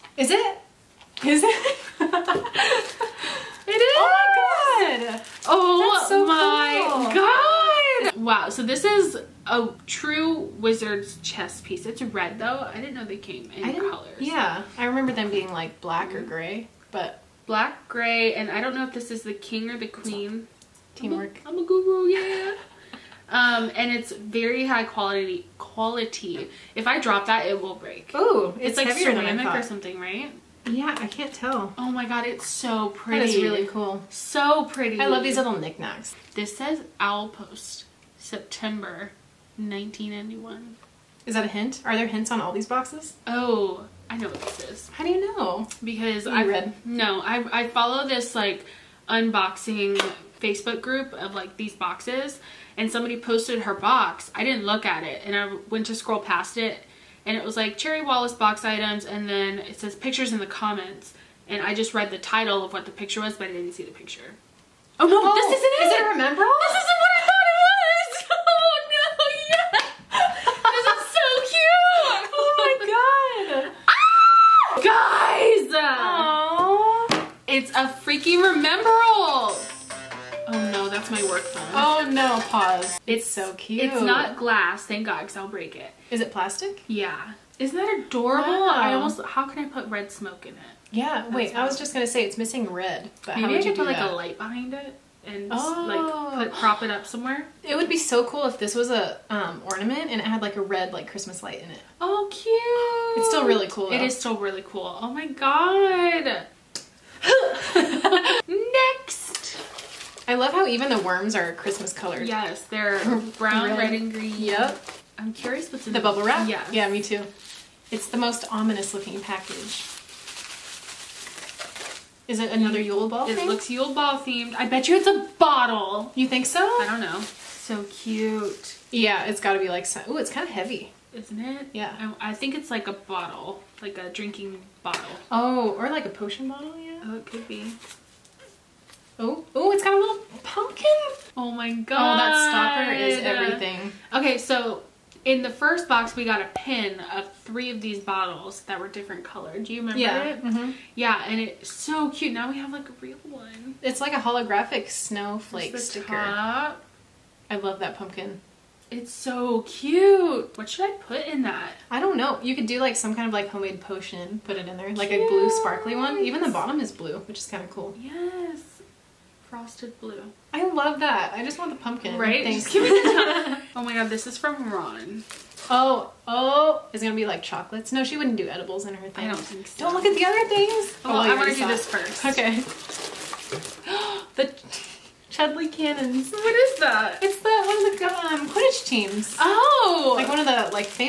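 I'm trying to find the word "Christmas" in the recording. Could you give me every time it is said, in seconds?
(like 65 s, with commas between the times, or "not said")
101 s, 111 s.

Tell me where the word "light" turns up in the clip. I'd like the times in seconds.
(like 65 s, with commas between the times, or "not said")
94 s, 101 s.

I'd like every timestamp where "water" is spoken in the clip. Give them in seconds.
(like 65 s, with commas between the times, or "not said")
not said.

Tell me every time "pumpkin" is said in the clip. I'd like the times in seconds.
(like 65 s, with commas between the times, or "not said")
140 s, 157 s, 171 s.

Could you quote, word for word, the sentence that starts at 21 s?
I'm a, I'm a guru, yeah.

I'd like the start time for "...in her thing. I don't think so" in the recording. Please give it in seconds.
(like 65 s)
178 s.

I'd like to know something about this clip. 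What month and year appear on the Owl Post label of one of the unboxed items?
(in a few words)
September 1991.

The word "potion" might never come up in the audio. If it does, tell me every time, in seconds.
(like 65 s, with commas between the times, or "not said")
136 s, 163 s.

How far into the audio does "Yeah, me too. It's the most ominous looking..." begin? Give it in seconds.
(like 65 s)
116 s.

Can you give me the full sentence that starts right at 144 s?
Okay, so in the first box we got a pin of three of these bottles that were different colored.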